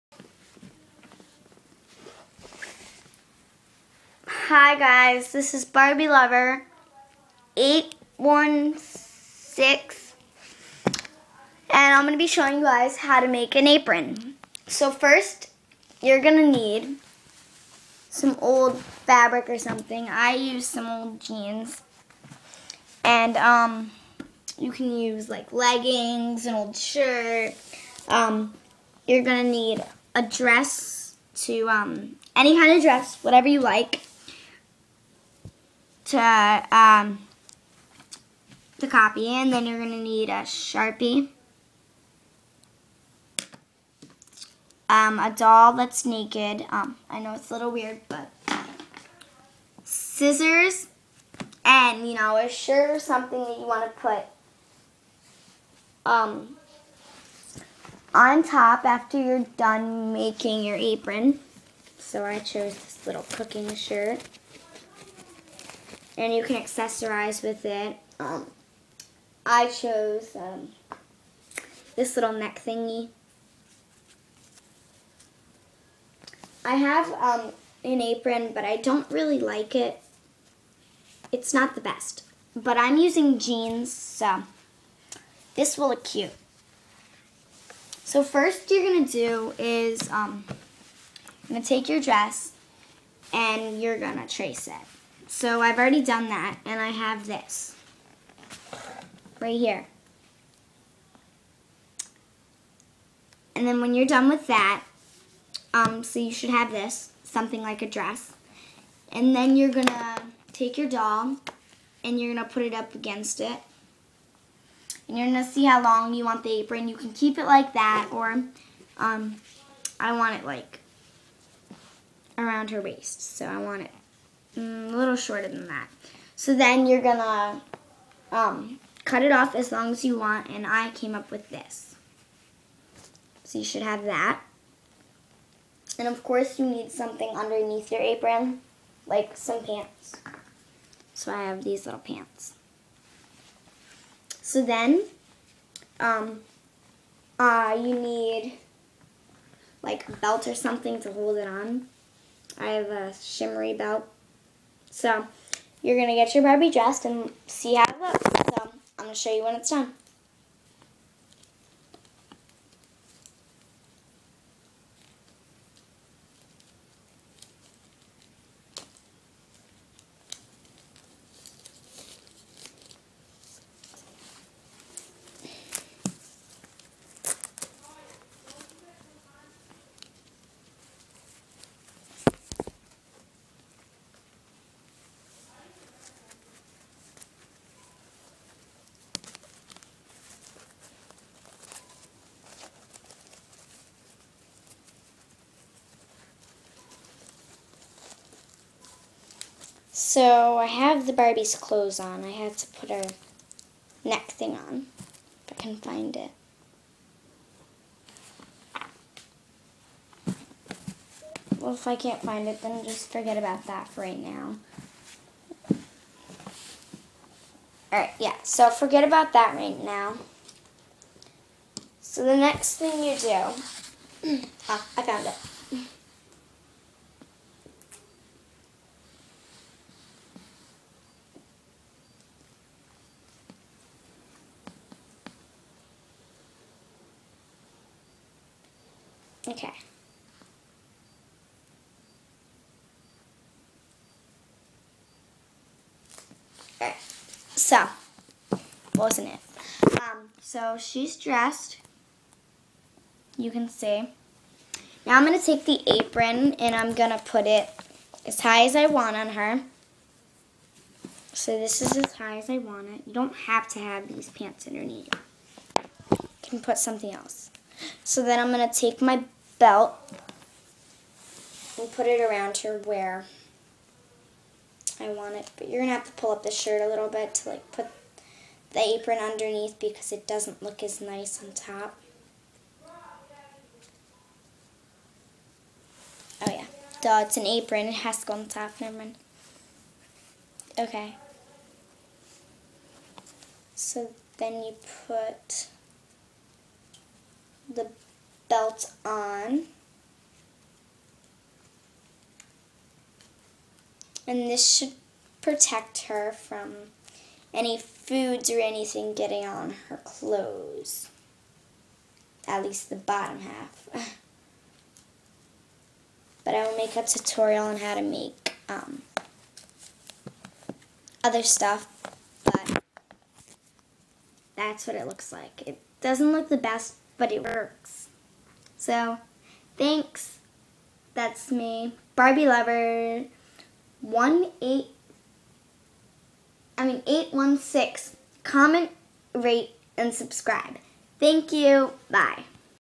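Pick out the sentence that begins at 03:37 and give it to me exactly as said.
Alright, yeah, so forget about that right now.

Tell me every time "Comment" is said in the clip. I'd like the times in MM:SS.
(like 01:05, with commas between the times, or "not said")
05:38.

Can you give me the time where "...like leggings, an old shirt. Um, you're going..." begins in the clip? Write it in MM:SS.
00:25.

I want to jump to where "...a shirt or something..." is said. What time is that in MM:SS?
00:52.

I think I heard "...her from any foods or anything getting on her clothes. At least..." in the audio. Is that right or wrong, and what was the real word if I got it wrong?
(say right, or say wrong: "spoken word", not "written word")
right.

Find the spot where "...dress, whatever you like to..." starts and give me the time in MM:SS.
00:32.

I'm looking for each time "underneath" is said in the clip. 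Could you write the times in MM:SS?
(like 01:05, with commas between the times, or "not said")
02:17, 04:24, 04:39.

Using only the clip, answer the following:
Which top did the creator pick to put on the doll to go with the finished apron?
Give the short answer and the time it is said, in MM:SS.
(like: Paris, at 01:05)
Cooking shirt, at 01:03.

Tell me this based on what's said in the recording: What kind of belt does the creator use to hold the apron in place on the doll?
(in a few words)
Shimmery belt.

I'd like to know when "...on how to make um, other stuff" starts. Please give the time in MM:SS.
05:17.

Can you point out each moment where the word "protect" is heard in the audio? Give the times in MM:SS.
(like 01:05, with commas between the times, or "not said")
05:05.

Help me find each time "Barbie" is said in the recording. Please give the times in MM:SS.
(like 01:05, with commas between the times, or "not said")
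00:05, 02:36, 03:21, 05:32.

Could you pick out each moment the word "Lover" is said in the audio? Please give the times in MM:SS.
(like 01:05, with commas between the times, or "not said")
00:06, 05:32.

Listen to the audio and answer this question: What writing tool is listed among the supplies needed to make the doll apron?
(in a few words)
Sharpie.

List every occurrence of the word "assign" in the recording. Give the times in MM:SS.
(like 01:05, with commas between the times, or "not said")
not said.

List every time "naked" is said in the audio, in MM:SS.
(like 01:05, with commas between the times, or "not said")
00:46.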